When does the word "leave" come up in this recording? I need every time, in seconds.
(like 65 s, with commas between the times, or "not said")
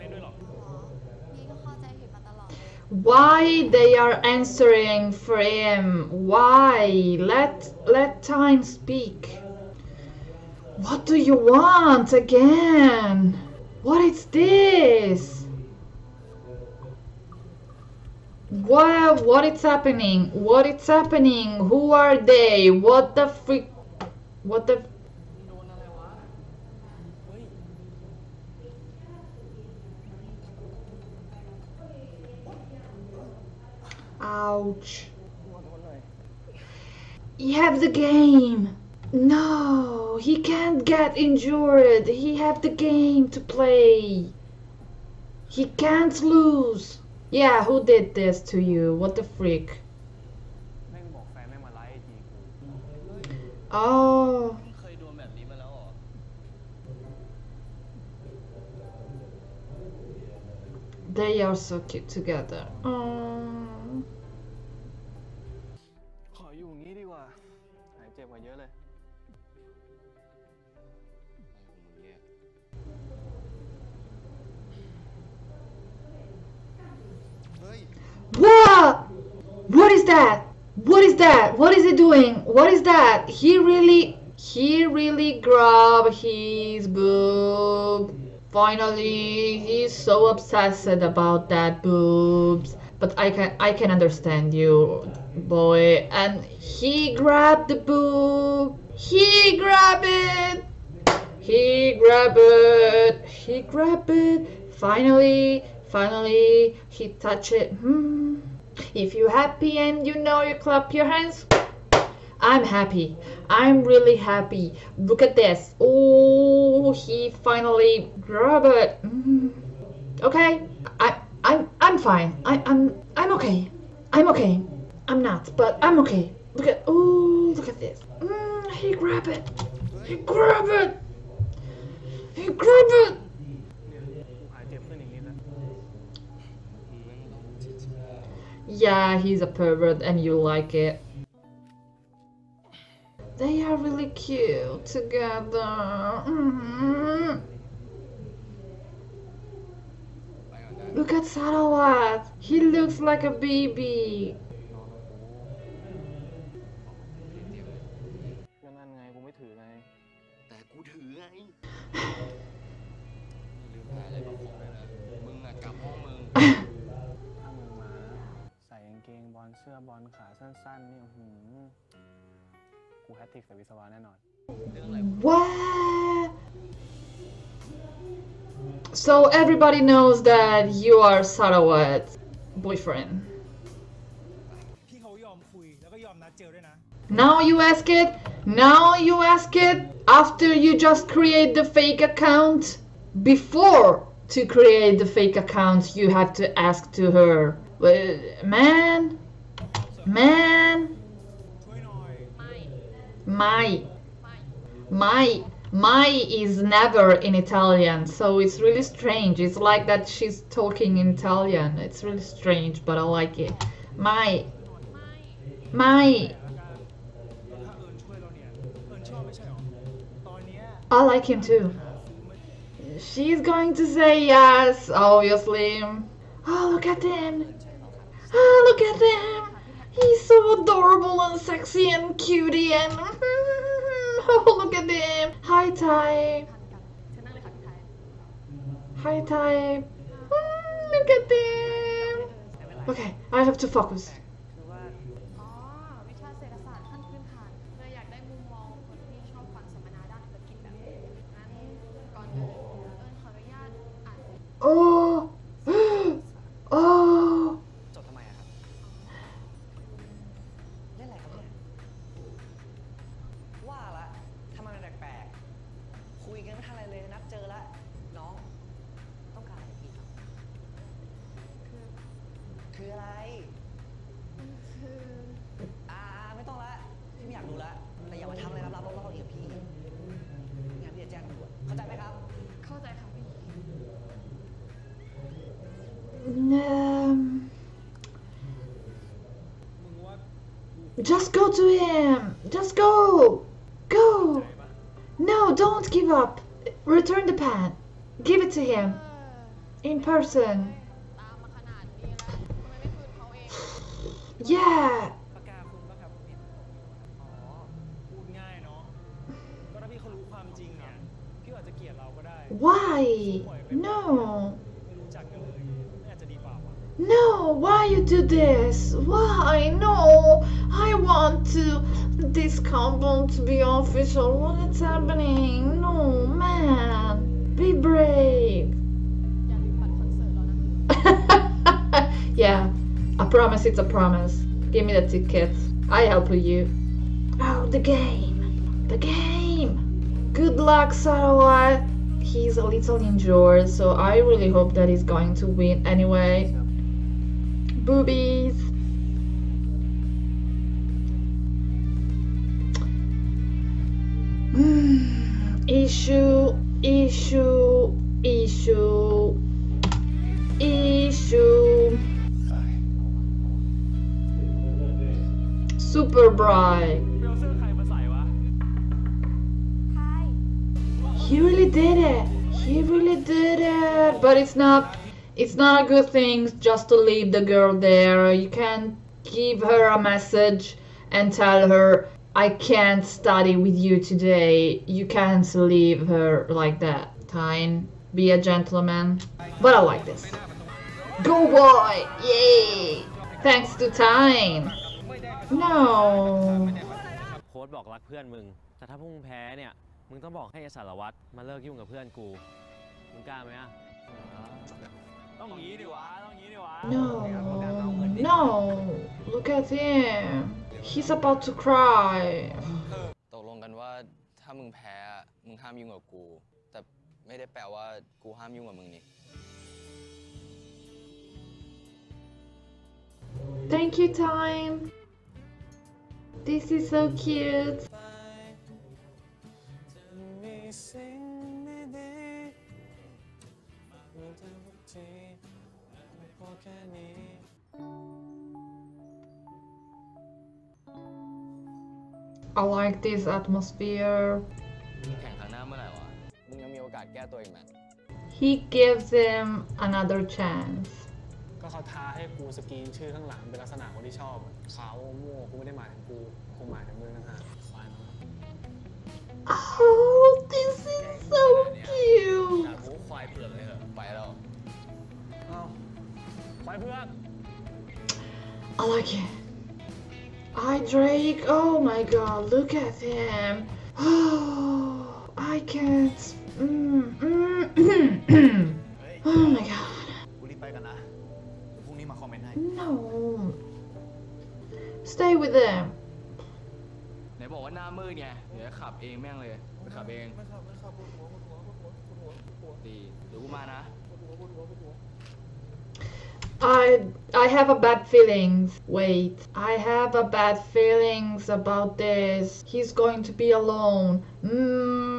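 376 s, 385 s.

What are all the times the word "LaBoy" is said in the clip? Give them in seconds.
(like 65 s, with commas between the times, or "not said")
not said.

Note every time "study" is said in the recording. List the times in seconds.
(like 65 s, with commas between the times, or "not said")
383 s.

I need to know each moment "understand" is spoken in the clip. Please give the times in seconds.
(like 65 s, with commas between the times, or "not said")
93 s.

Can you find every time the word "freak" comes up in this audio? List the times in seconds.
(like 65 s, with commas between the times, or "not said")
23 s, 49 s.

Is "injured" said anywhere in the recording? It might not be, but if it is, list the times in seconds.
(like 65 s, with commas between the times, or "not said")
41 s, 343 s.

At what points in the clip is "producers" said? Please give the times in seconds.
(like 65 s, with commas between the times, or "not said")
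not said.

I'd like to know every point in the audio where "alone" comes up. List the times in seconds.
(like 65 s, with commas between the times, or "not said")
503 s.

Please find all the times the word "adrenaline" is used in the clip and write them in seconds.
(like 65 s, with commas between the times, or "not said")
not said.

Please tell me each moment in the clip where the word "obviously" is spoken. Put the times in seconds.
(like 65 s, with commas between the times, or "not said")
224 s.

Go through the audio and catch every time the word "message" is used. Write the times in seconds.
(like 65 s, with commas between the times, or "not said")
380 s.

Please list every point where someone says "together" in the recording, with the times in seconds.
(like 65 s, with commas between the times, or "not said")
62 s, 144 s.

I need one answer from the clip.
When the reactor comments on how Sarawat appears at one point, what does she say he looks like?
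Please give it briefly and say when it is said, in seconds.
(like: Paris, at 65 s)
a baby, at 153 s.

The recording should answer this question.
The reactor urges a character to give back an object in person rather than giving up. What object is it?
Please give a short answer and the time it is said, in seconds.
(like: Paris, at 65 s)
the pen, at 297 s.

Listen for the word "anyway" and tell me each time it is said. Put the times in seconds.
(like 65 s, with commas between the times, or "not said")
345 s.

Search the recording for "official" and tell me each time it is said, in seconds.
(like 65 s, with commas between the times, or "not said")
323 s.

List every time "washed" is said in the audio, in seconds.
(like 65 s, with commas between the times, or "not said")
not said.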